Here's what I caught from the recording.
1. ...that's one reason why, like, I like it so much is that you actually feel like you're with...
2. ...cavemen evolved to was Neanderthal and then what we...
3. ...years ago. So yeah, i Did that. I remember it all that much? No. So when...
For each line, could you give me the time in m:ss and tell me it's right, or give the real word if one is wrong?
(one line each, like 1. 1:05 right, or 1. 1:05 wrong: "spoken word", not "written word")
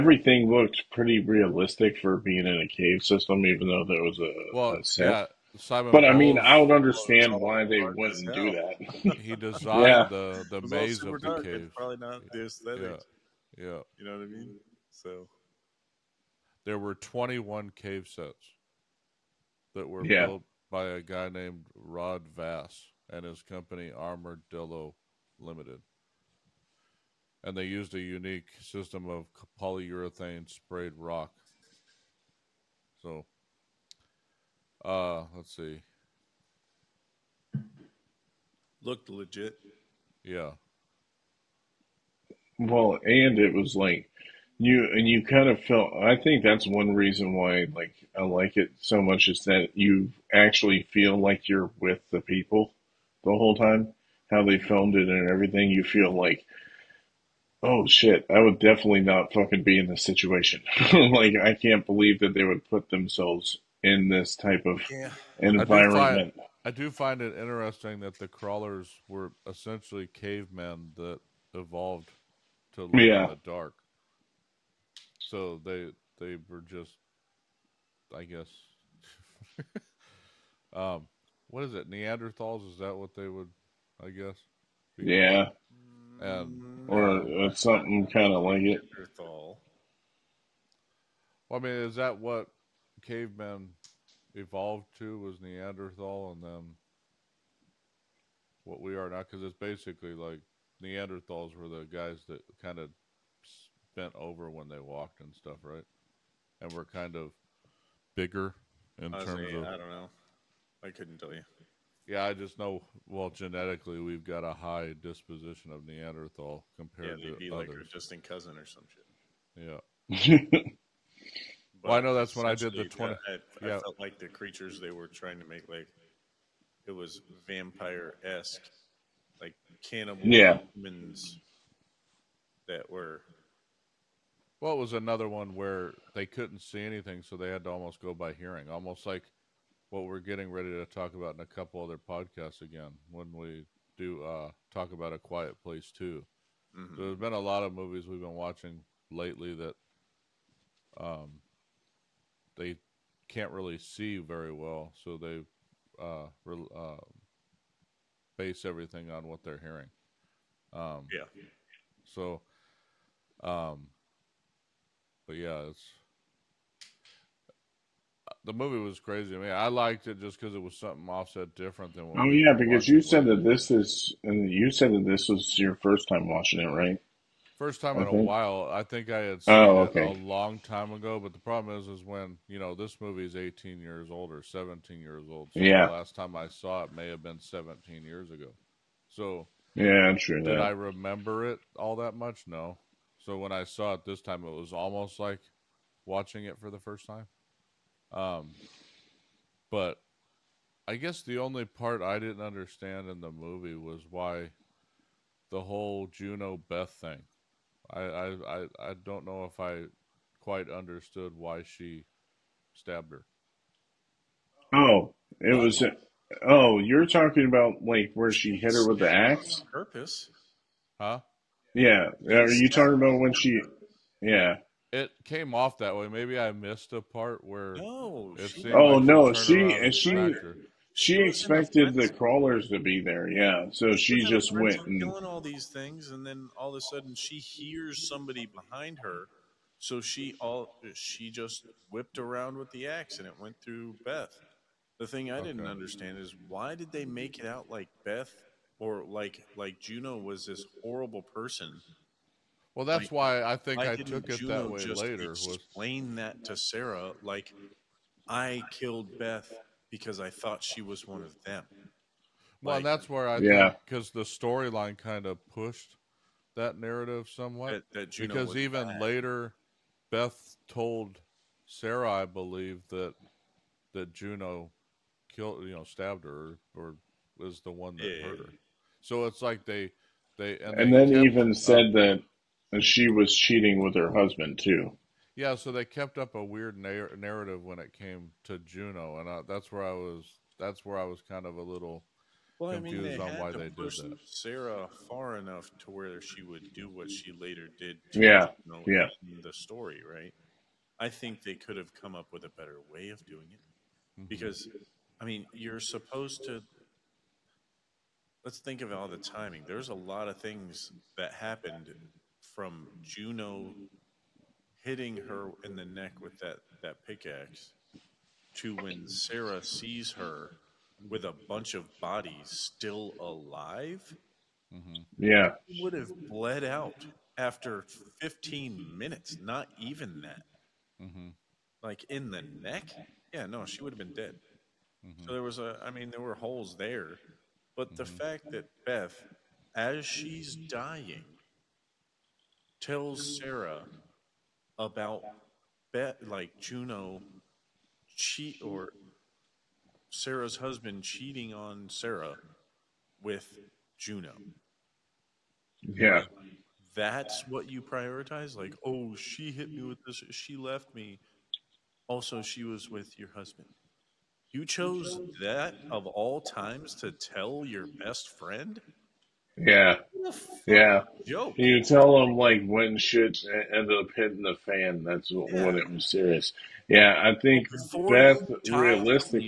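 1. 0:46 right
2. 1:33 right
3. 3:08 right.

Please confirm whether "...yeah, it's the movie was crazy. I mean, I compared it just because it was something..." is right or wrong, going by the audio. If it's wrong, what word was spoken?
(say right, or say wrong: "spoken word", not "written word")
wrong: "liked", not "compared".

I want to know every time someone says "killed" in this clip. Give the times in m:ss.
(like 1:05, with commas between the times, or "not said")
4:18, 4:35.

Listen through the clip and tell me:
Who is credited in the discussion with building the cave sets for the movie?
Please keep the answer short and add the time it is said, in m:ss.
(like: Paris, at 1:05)
Rod Vass, at 0:21.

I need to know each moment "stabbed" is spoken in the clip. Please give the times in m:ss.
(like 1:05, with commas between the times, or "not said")
3:32, 4:35.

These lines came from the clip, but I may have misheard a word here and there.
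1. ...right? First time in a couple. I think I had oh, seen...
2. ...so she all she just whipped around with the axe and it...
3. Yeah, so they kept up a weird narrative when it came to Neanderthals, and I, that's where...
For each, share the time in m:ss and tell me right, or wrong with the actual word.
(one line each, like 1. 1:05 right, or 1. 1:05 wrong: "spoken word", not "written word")
1. 2:56 wrong: "while", not "couple"
2. 3:59 right
3. 4:45 wrong: "Juno", not "Neanderthals".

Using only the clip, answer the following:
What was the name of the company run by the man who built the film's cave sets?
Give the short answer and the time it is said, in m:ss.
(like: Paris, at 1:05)
Armadillo Limited, at 0:23.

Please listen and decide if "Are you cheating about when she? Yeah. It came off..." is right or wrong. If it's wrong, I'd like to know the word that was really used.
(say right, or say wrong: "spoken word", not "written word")
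wrong: "talking", not "cheating".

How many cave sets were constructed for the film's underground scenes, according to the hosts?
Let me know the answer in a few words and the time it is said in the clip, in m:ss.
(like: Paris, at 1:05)
21, at 0:16.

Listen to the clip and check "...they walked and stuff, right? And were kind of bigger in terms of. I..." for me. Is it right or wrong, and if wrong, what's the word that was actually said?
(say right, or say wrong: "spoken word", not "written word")
right.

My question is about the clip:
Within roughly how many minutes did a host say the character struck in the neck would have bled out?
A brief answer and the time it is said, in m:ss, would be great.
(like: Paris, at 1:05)
15 minutes, at 5:28.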